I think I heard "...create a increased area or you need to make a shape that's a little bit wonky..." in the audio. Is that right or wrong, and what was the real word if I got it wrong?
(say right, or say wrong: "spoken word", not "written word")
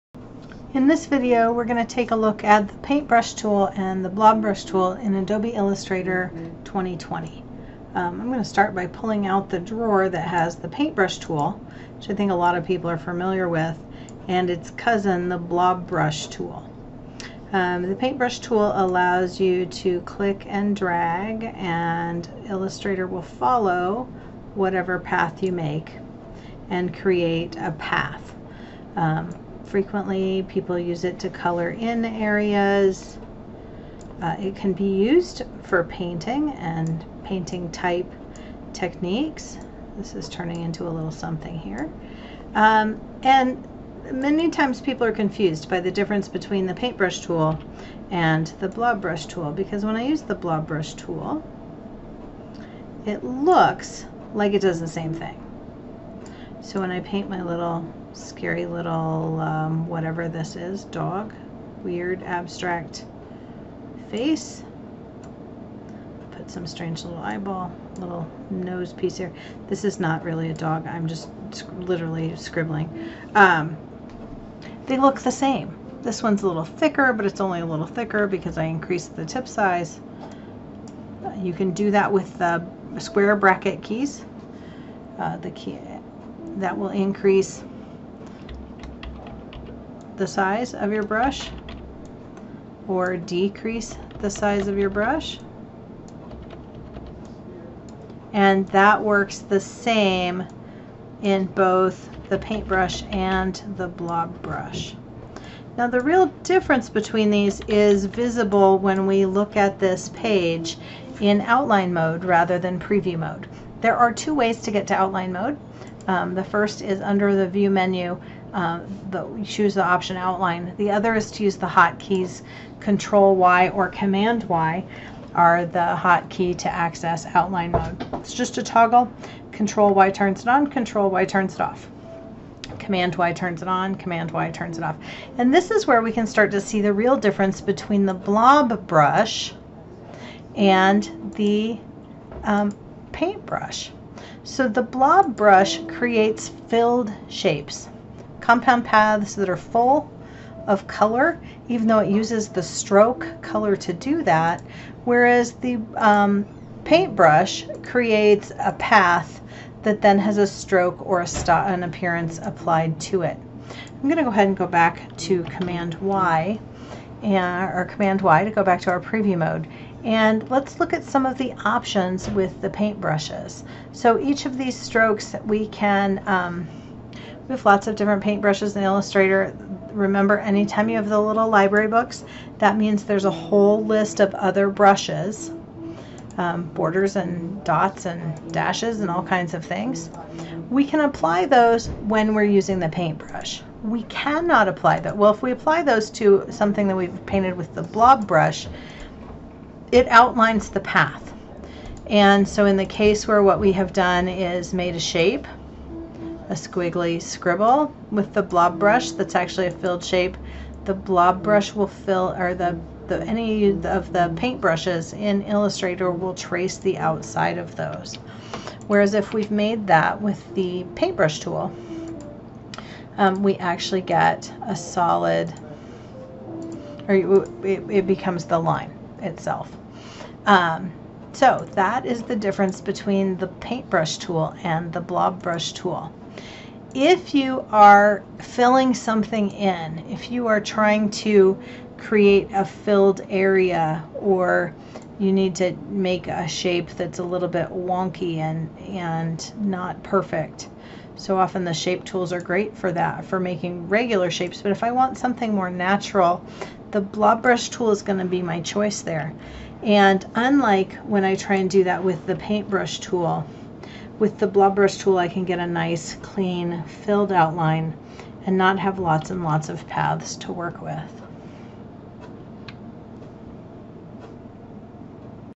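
wrong: "filled", not "increased".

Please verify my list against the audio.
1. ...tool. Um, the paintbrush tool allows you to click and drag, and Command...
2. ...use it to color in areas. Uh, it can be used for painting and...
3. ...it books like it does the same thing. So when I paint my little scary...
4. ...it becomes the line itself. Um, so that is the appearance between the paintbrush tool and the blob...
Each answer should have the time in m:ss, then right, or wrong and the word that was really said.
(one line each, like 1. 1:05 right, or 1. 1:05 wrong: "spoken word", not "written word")
1. 0:16 wrong: "Illustrator", not "Command"
2. 0:30 right
3. 0:53 wrong: "looks", not "books"
4. 3:47 wrong: "difference", not "appearance".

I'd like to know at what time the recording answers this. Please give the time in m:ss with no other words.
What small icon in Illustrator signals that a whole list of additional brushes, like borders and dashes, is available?
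3:01.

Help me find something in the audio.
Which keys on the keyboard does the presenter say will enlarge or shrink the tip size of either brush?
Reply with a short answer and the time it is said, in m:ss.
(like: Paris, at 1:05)
Square bracket keys, at 1:22.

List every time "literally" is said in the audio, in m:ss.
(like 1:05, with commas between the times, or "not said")
1:11.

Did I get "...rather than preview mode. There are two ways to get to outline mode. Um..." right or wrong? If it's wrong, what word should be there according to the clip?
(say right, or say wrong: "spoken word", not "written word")
right.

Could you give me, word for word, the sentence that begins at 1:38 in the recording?
And that works the same in both the paintbrush and the blob brush.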